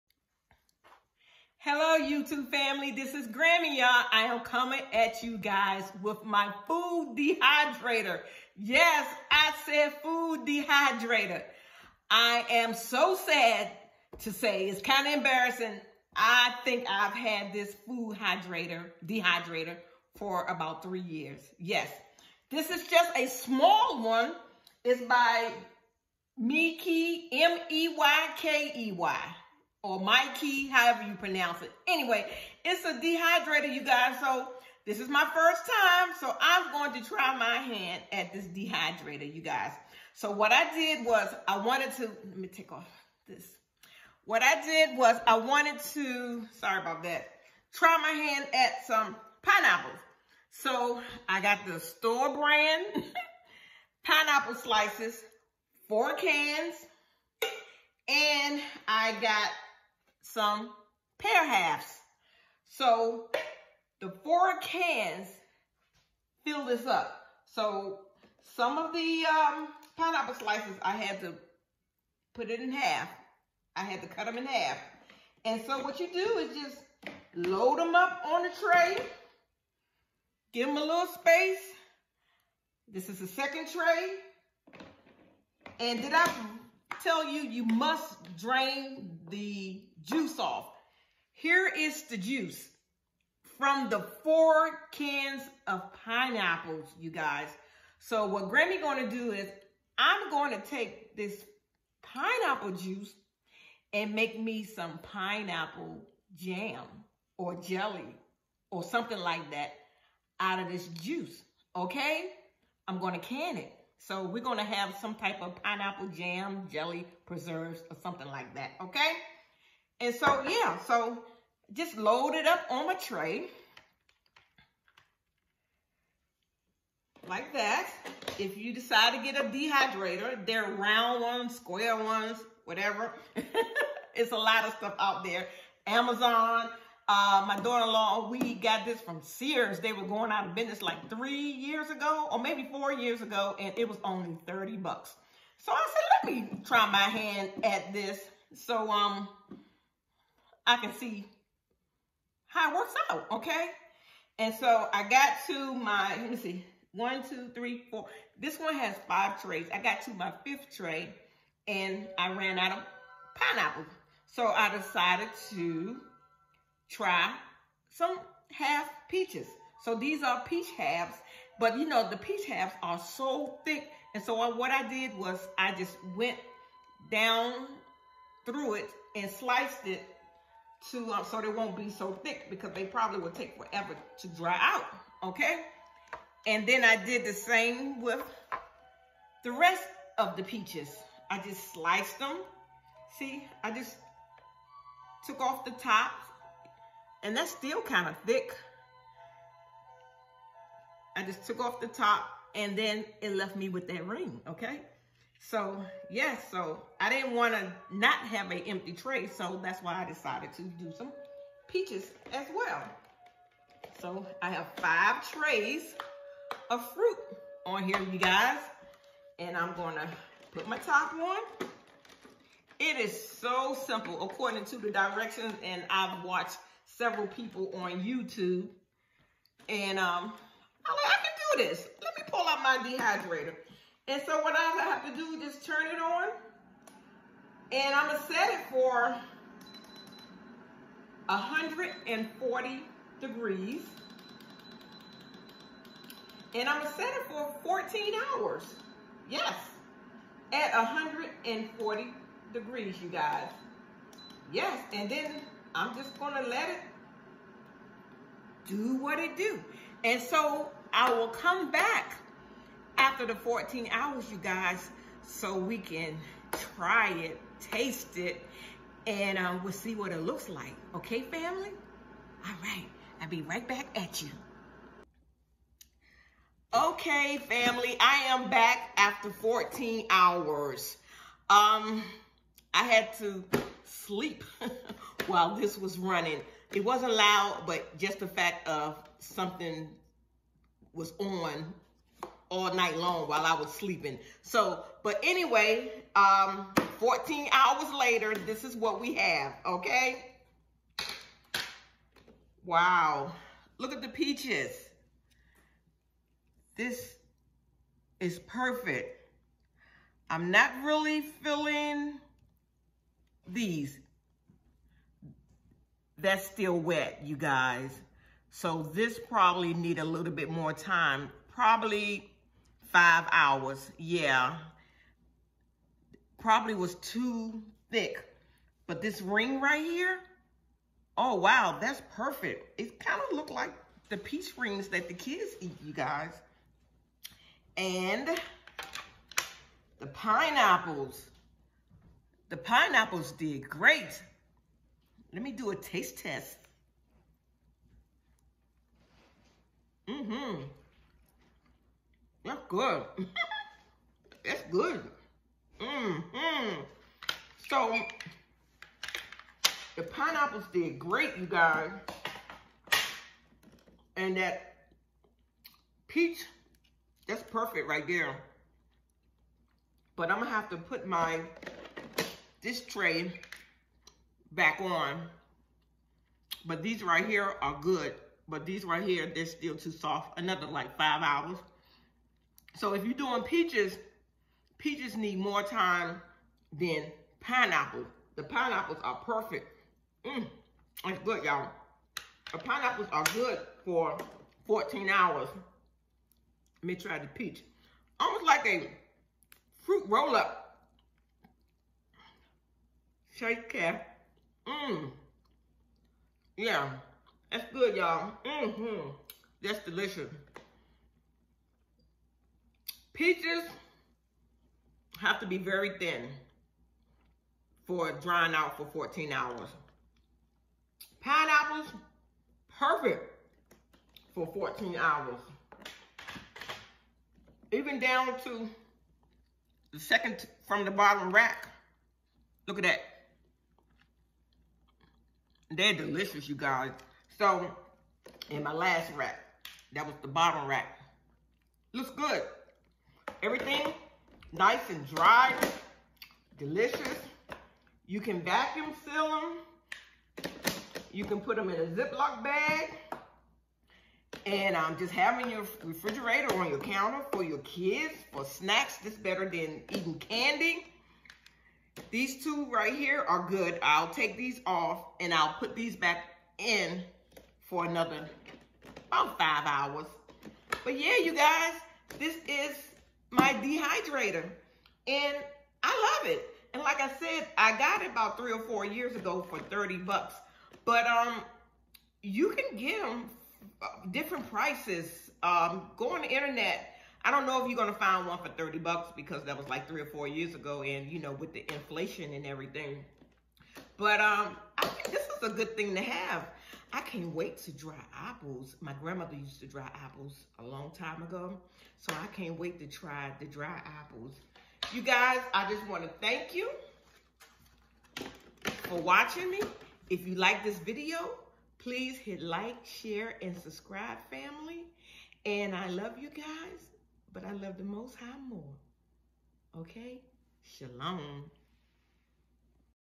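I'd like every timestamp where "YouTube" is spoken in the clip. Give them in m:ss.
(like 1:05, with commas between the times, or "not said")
0:02, 3:48.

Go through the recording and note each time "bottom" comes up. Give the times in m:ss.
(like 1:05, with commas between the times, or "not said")
7:10, 7:20.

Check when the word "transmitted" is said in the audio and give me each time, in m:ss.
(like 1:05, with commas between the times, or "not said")
not said.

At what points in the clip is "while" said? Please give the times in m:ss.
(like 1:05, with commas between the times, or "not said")
4:45, 4:53.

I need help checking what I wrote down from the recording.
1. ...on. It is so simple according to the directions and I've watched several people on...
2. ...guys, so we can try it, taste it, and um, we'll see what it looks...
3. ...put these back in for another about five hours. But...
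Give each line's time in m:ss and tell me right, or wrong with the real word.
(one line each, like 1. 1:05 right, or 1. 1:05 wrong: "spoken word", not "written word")
1. 3:41 right
2. 4:24 right
3. 7:45 right.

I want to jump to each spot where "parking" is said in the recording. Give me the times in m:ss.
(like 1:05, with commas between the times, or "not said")
not said.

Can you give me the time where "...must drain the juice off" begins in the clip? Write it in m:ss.
1:27.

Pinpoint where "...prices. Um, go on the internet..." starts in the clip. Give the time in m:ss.
8:04.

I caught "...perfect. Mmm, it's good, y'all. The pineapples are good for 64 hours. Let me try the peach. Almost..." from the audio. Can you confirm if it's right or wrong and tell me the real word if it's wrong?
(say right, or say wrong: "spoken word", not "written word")
wrong: "14", not "64".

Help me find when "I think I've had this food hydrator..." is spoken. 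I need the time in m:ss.
0:16.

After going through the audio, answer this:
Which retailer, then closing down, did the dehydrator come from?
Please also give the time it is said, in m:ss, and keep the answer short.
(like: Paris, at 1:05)
Sears, at 2:19.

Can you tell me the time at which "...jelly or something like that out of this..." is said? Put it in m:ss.
1:47.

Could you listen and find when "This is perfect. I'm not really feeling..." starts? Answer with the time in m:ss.
5:06.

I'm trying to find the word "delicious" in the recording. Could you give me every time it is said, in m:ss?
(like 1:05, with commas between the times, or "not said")
6:49, 7:15, 7:26.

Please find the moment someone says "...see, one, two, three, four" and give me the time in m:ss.
2:36.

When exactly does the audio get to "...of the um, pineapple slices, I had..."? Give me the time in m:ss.
1:08.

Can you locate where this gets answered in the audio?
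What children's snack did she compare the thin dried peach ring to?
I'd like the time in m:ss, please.
5:34.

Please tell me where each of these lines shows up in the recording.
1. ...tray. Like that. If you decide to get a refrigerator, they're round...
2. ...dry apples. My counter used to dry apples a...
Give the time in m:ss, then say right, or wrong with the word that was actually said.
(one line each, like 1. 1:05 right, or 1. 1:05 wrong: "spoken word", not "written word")
1. 2:02 wrong: "dehydrator", not "refrigerator"
2. 8:17 wrong: "grandmother", not "counter".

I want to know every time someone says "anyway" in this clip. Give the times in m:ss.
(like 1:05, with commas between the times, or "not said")
0:31, 4:55.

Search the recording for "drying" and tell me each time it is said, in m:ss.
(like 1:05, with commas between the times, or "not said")
6:58.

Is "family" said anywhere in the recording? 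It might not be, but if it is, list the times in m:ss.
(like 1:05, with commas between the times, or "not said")
0:02, 4:31, 4:37, 8:34.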